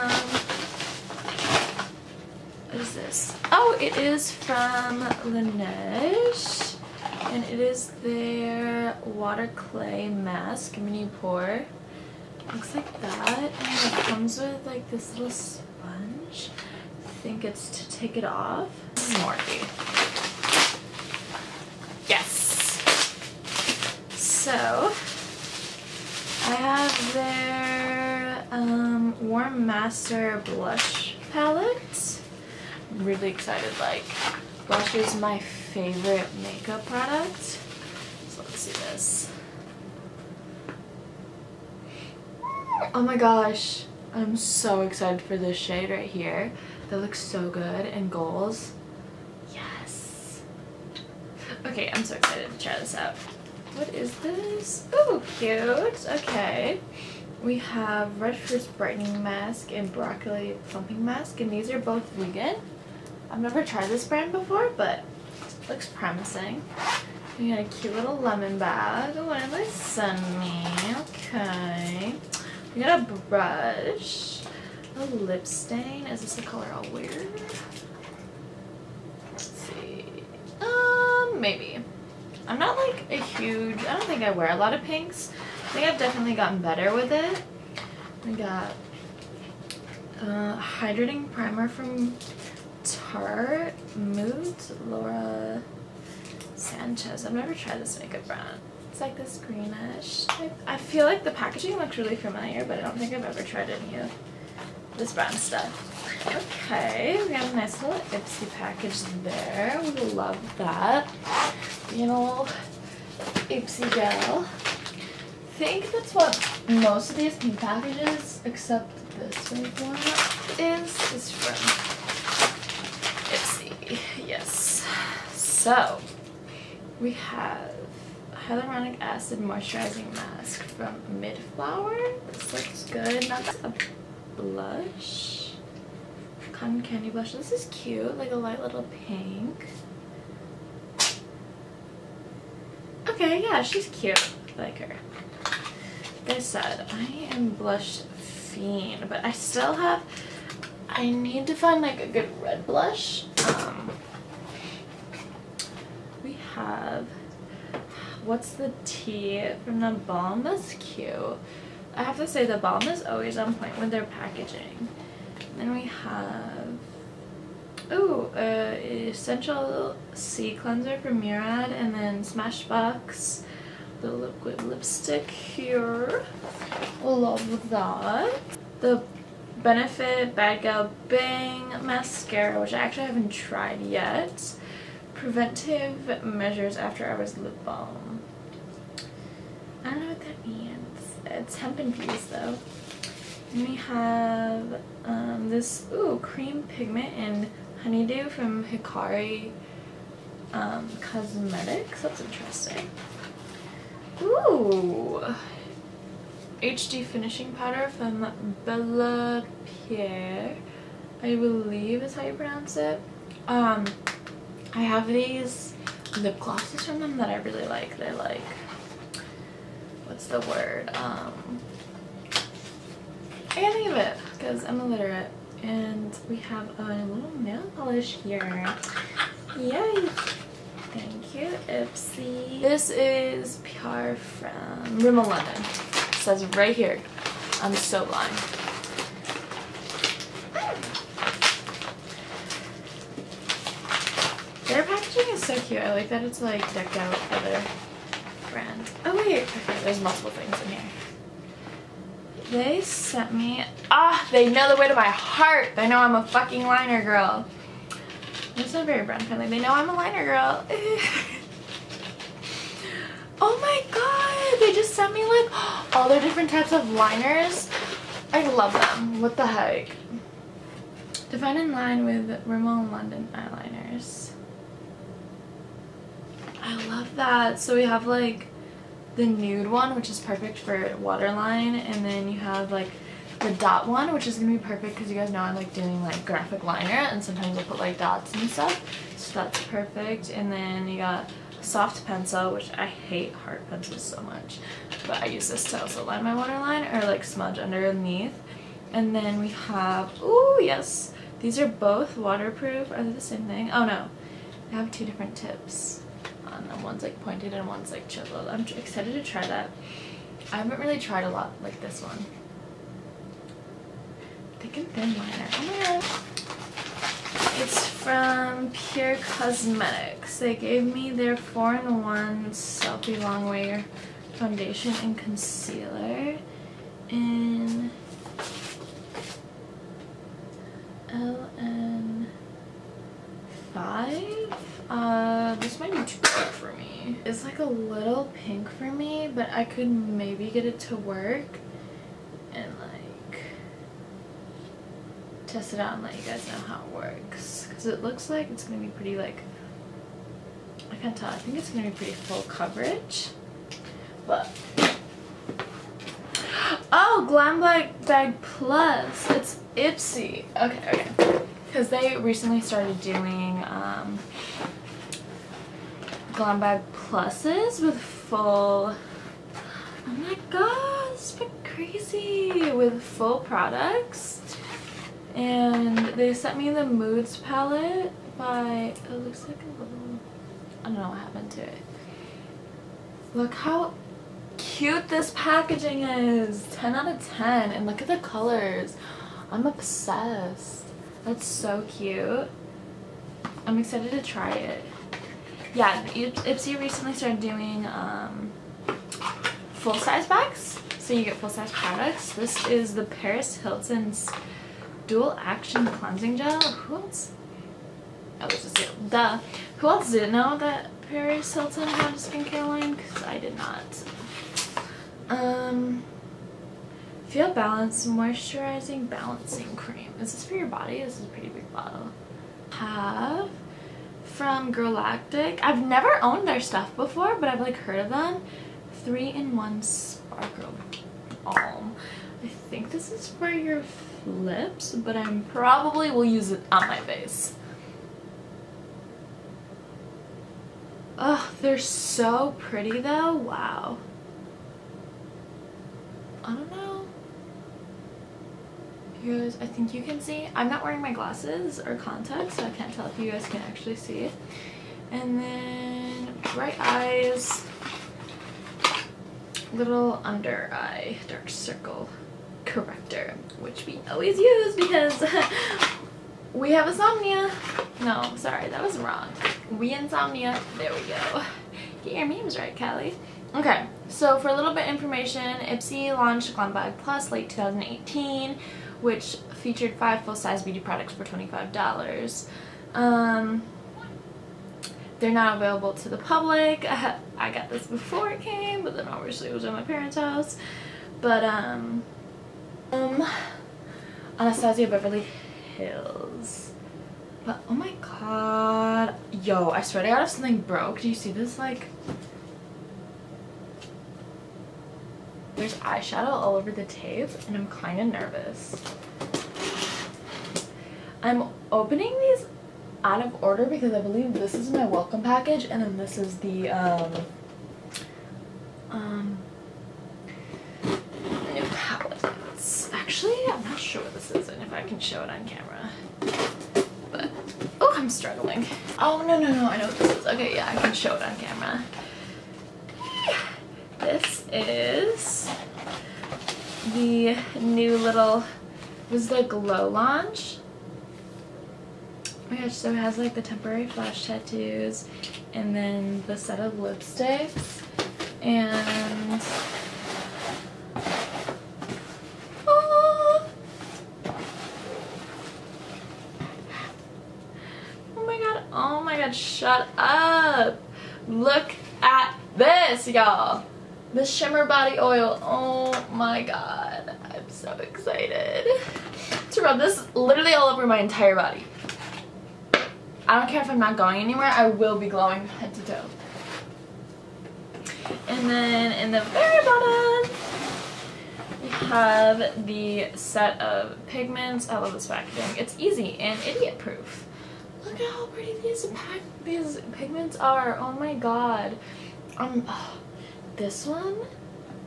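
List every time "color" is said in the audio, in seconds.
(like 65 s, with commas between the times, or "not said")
76 s, 388 s.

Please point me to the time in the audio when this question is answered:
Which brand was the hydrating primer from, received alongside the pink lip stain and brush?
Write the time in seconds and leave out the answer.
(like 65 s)
92 s.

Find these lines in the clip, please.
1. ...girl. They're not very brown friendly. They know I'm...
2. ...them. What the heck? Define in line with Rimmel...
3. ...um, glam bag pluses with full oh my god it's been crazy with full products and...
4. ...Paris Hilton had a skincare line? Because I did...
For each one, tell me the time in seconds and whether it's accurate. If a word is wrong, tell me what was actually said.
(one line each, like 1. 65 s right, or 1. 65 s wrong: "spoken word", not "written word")
1. 257 s right
2. 268 s right
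3. 363 s right
4. 411 s right.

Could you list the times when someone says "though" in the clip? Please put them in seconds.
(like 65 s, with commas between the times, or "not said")
192 s, 443 s.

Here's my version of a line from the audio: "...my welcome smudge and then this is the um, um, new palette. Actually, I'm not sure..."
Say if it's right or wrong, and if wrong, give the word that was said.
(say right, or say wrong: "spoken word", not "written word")
wrong: "package", not "smudge".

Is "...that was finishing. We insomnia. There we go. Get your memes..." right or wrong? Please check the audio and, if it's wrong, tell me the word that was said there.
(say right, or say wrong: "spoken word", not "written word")
wrong: "wrong", not "finishing".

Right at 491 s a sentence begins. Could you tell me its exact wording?
But, um, um, Anastasia Beverly Hills.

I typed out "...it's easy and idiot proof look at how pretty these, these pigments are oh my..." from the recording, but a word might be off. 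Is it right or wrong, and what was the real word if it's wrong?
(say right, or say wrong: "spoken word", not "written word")
right.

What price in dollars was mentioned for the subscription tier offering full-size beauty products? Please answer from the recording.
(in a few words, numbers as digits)
$25.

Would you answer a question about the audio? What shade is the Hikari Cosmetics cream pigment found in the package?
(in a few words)
Honeydew.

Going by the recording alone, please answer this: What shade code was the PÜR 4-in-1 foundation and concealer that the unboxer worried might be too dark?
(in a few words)
LN5.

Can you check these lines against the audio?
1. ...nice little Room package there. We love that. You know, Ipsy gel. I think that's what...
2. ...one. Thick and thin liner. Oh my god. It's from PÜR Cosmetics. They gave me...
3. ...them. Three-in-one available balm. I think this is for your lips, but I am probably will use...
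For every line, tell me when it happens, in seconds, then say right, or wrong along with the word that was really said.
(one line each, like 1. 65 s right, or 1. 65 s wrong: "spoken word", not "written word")
1. 107 s wrong: "Ipsy", not "Room"
2. 312 s right
3. 428 s wrong: "sparkle", not "available".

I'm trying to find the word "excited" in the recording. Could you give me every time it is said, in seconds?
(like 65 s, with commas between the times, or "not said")
33 s, 44 s, 52 s, 308 s, 393 s, 567 s.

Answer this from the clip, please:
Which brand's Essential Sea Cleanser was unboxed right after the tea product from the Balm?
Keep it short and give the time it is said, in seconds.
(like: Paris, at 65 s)
Murad, at 171 s.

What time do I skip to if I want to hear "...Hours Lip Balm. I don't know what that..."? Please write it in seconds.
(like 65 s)
187 s.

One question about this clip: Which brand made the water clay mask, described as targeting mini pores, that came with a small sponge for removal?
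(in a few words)
Laneige.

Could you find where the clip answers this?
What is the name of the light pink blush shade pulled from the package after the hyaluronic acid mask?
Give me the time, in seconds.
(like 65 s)
136 s.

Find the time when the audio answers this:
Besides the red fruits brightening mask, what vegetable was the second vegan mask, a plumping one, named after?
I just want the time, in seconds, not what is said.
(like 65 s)
59 s.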